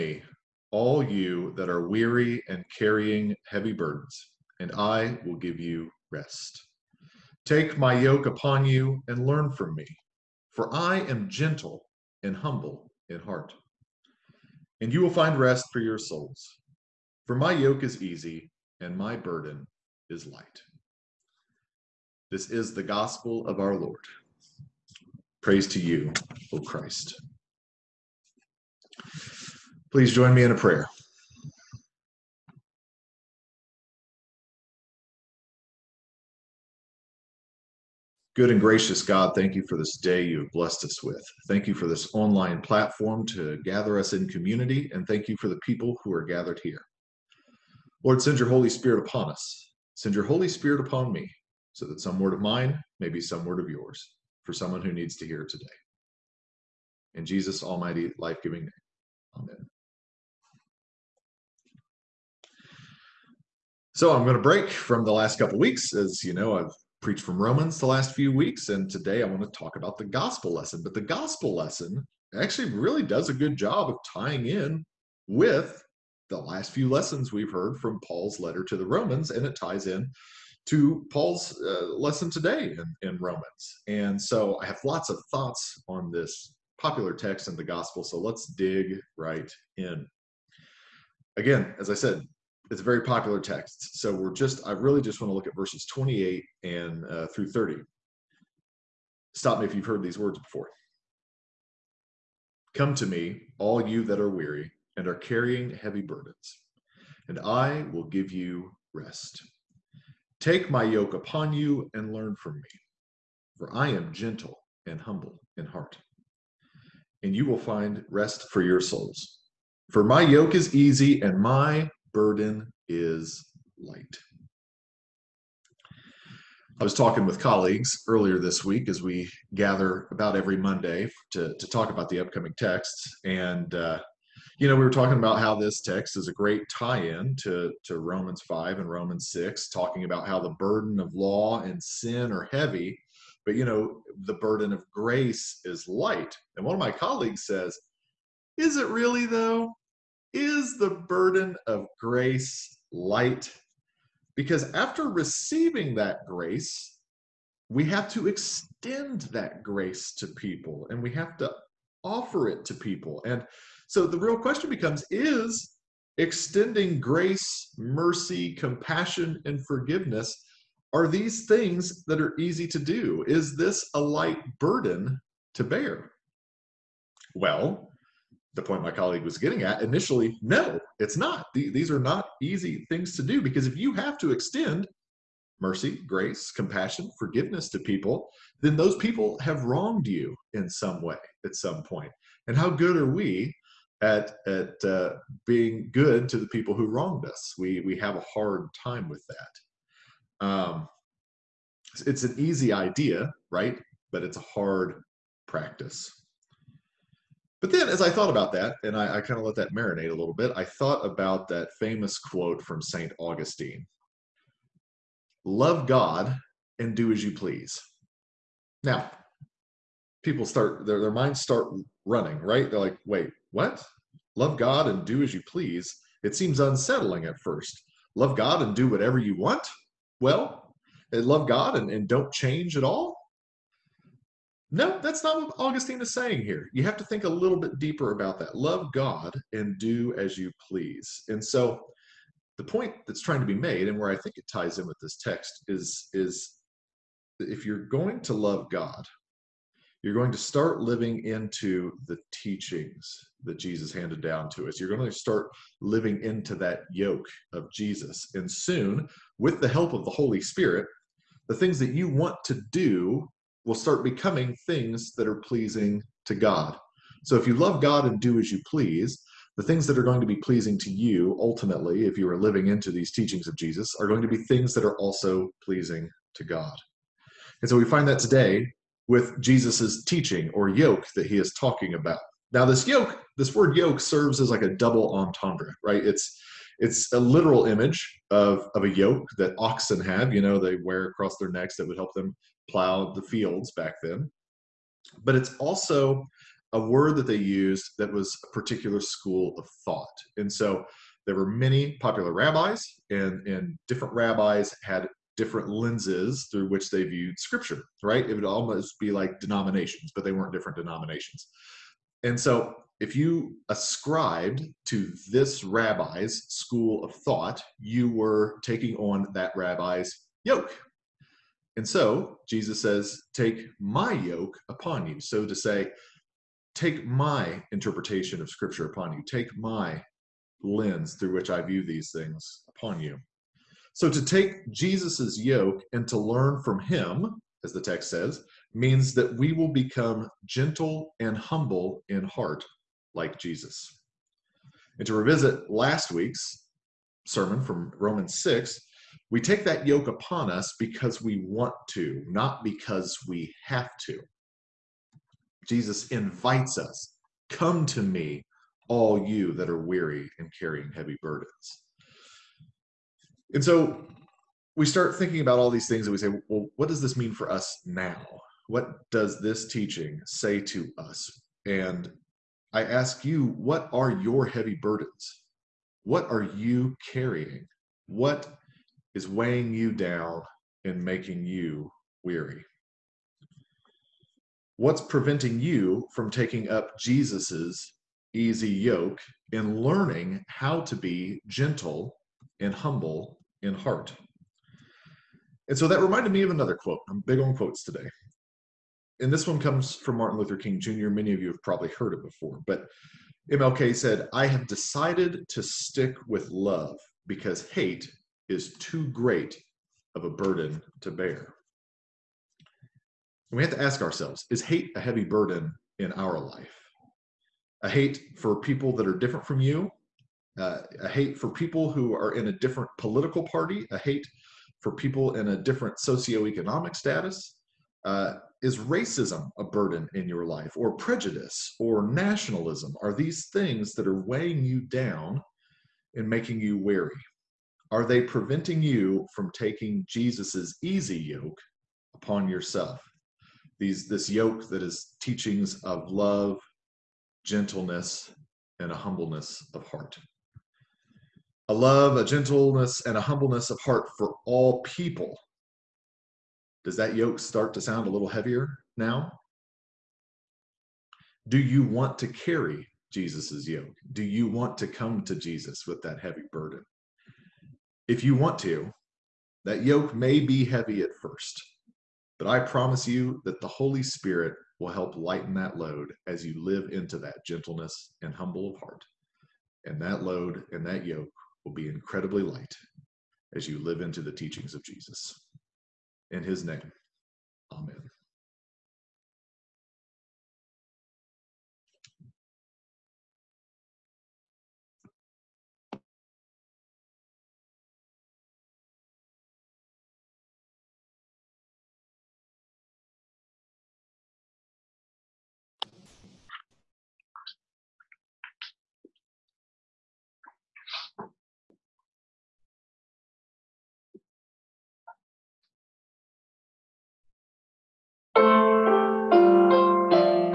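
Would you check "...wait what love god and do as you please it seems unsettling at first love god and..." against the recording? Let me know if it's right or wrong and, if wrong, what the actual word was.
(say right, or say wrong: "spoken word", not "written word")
right.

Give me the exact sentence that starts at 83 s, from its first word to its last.
And so I have lots of thoughts on this popular text in the gospel.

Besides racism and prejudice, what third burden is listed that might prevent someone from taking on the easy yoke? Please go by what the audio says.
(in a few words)
Nationalism.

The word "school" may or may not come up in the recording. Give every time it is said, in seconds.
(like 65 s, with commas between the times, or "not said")
299 s, 316 s.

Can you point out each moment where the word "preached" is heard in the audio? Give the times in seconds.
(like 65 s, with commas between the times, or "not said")
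67 s.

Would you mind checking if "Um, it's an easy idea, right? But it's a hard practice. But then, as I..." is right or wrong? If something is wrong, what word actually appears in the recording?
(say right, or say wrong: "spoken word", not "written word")
right.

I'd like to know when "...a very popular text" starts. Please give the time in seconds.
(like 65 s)
92 s.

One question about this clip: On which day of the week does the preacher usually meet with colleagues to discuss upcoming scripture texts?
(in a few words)
Monday.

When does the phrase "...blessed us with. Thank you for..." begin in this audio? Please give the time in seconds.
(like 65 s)
40 s.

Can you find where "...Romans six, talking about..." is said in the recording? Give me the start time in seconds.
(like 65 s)
138 s.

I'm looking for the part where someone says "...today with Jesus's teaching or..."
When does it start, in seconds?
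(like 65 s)
278 s.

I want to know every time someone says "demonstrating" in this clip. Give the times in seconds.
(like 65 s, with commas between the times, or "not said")
not said.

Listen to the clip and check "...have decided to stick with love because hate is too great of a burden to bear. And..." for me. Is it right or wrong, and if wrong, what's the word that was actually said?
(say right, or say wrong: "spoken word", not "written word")
right.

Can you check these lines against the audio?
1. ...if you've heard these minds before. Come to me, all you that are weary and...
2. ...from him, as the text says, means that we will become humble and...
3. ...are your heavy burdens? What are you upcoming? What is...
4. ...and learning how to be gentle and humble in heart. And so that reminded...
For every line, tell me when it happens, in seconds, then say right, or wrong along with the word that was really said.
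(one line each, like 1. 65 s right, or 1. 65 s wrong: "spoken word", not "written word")
1. 99 s wrong: "words", not "minds"
2. 336 s wrong: "gentle", not "humble"
3. 373 s wrong: "carrying", not "upcoming"
4. 389 s right.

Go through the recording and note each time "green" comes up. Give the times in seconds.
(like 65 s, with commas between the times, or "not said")
not said.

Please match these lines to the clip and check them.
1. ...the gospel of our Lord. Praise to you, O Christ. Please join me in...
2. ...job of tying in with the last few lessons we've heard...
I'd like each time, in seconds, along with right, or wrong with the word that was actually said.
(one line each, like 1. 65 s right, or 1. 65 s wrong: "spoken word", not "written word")
1. 22 s right
2. 73 s right.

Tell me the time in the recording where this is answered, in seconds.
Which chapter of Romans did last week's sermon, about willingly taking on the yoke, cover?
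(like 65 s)
347 s.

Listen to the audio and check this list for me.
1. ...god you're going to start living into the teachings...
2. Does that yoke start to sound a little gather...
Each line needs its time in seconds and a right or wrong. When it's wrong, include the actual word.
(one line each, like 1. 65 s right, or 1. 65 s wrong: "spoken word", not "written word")
1. 248 s right
2. 456 s wrong: "heavier", not "gather".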